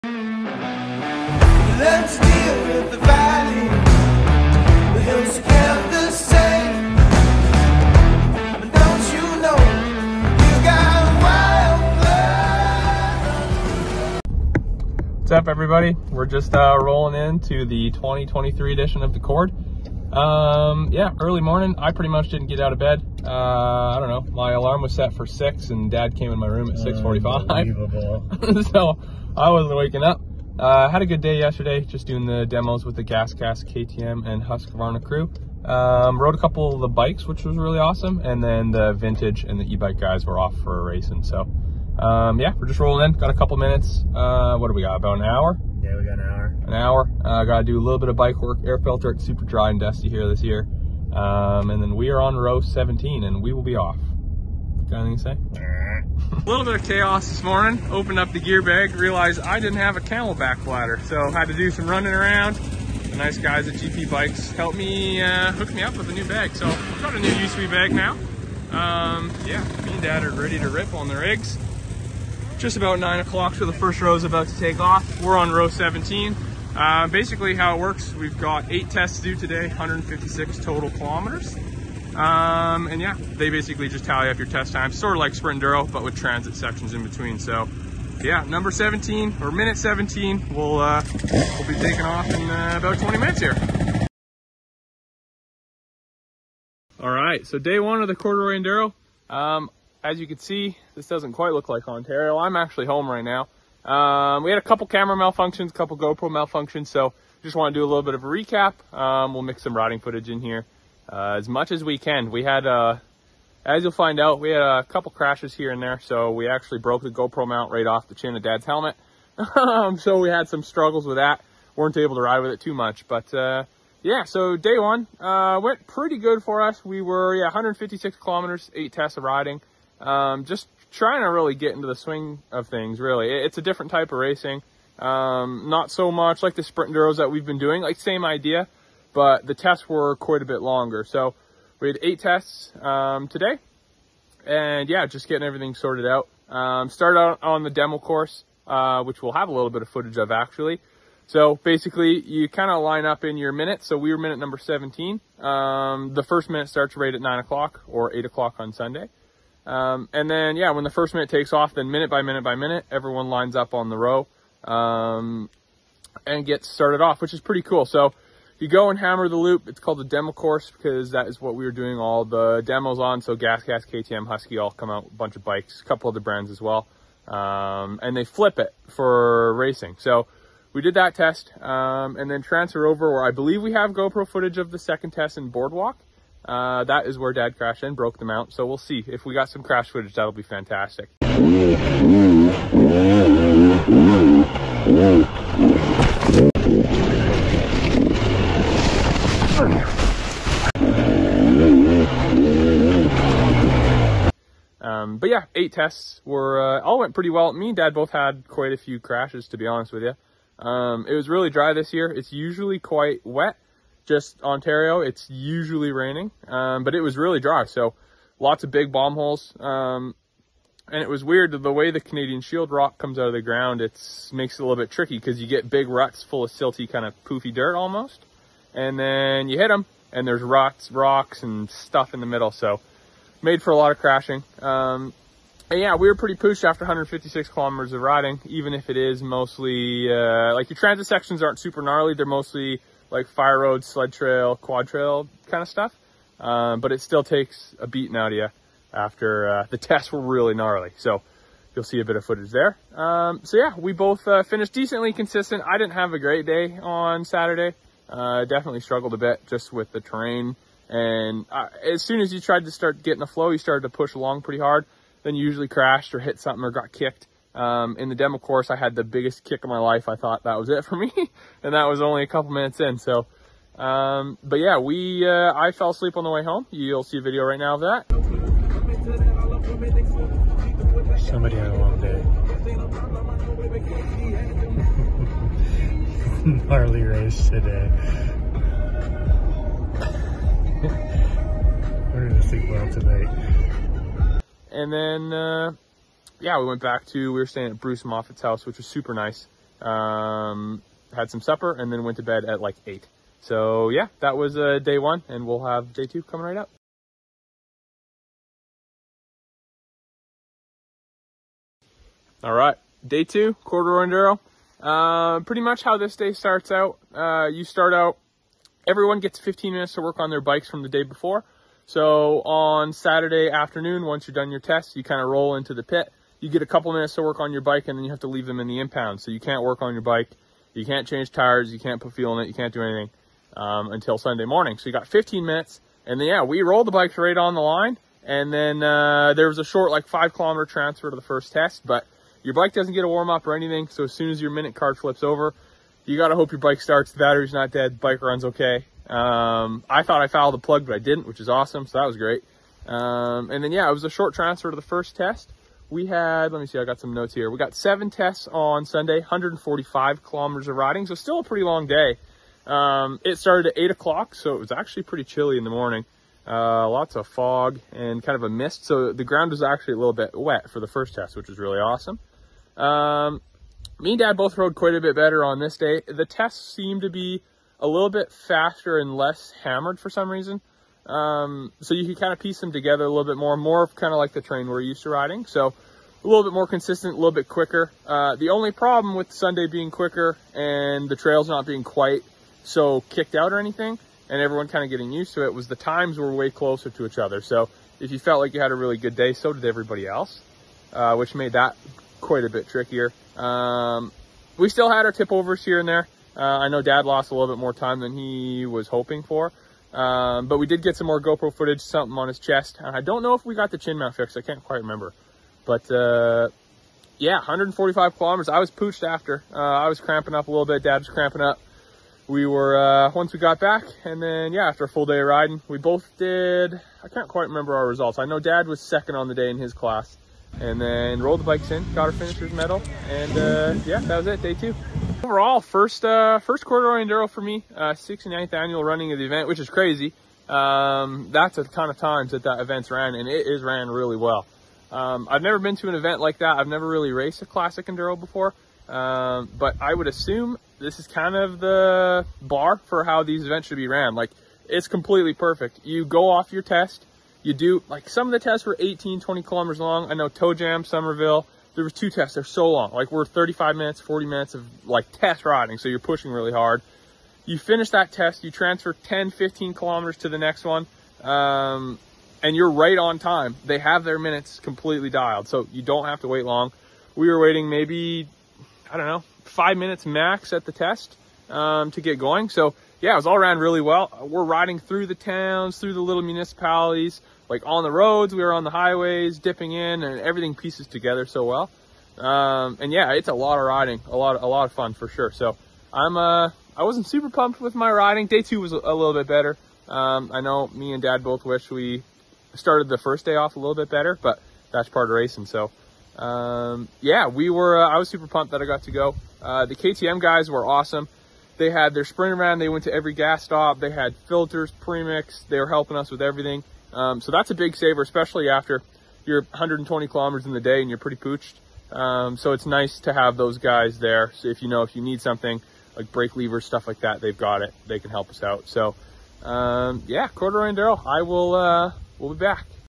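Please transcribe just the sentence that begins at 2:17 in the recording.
Like same idea, but the tests were quite a bit longer.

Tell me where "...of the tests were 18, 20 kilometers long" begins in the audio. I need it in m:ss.
7:38.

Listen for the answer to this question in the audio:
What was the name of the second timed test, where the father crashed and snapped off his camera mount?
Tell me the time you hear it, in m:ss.
3:05.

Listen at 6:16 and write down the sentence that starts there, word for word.
The tests seemed to be a little bit faster and less hammered for some reason.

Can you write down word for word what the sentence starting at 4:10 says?
So you'll see a bit of footage there.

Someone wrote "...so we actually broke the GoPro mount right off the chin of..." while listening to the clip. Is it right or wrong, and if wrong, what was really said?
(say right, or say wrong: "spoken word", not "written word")
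right.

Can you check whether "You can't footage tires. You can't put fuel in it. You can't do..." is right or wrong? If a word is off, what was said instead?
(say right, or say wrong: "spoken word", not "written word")
wrong: "change", not "footage".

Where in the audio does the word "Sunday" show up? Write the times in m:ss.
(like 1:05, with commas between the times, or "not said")
2:38, 5:34, 5:58, 6:29.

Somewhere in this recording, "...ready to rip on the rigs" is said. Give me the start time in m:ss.
1:10.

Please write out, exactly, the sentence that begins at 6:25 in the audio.
So a little bit more consistent, a little bit quicker.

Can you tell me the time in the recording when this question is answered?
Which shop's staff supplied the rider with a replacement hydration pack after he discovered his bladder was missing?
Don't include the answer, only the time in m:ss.
1:03.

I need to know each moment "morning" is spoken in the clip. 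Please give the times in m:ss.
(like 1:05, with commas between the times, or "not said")
0:21, 0:57, 5:34, 6:05.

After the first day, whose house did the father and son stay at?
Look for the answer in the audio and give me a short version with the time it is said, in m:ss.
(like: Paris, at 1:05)
Bruce Moffat, at 4:57.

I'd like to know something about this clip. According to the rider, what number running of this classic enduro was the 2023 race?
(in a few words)
69th.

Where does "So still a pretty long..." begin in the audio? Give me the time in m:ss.
6:01.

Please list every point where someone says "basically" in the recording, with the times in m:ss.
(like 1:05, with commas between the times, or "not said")
1:17, 1:23, 2:31.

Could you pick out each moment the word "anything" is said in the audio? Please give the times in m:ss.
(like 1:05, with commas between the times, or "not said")
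0:55, 5:32, 5:43, 6:33.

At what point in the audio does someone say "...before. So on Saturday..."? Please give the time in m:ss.
5:21.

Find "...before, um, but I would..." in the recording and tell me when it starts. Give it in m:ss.
7:28.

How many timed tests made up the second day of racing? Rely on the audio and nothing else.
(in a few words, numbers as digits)
7.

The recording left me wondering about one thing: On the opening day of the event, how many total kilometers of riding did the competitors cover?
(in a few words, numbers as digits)
156.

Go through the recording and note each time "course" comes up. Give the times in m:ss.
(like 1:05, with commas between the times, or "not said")
2:27, 2:50, 4:28.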